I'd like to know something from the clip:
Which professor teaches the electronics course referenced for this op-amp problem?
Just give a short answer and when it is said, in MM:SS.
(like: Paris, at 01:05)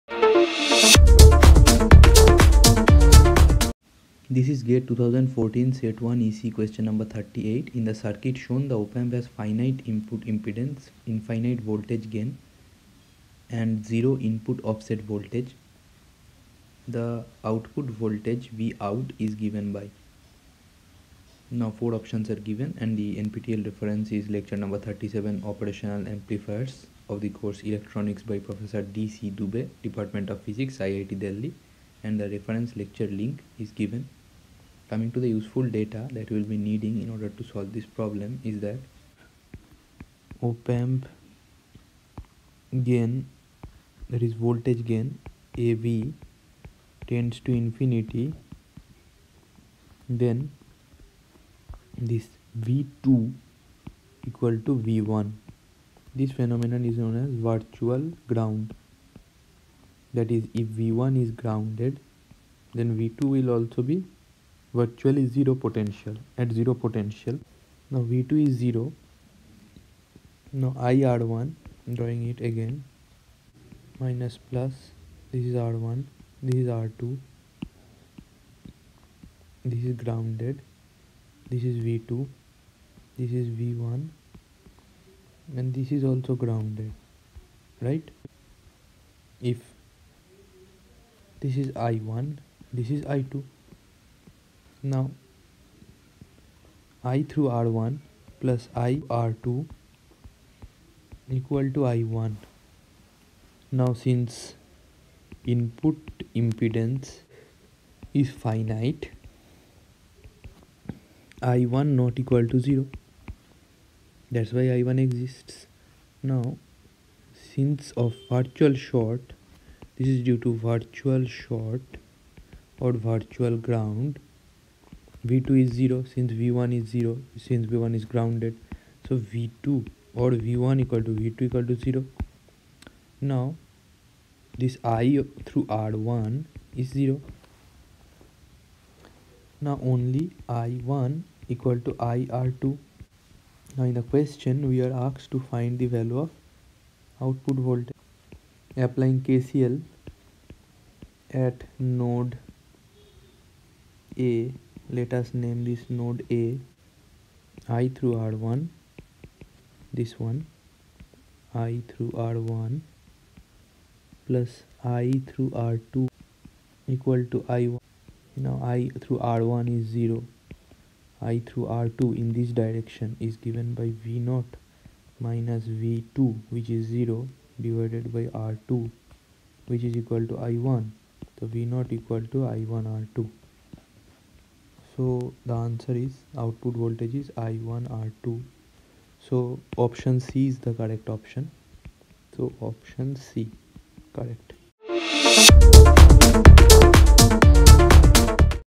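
D.C. Dube, at 00:28.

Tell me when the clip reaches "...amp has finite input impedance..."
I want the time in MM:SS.
00:08.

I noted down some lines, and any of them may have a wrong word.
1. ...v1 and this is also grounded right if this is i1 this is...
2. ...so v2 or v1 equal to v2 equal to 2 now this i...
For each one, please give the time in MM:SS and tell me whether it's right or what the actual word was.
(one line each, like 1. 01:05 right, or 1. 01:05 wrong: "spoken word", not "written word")
1. 01:23 right
2. 02:09 wrong: "0", not "2".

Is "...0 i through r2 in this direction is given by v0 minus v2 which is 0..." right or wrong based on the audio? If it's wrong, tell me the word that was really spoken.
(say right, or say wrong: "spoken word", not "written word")
right.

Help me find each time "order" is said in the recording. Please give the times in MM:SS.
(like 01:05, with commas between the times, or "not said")
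00:37.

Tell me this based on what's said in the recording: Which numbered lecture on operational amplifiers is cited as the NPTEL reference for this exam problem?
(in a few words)
37.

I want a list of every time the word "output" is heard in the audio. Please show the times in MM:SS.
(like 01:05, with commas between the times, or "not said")
00:17, 02:27, 03:06.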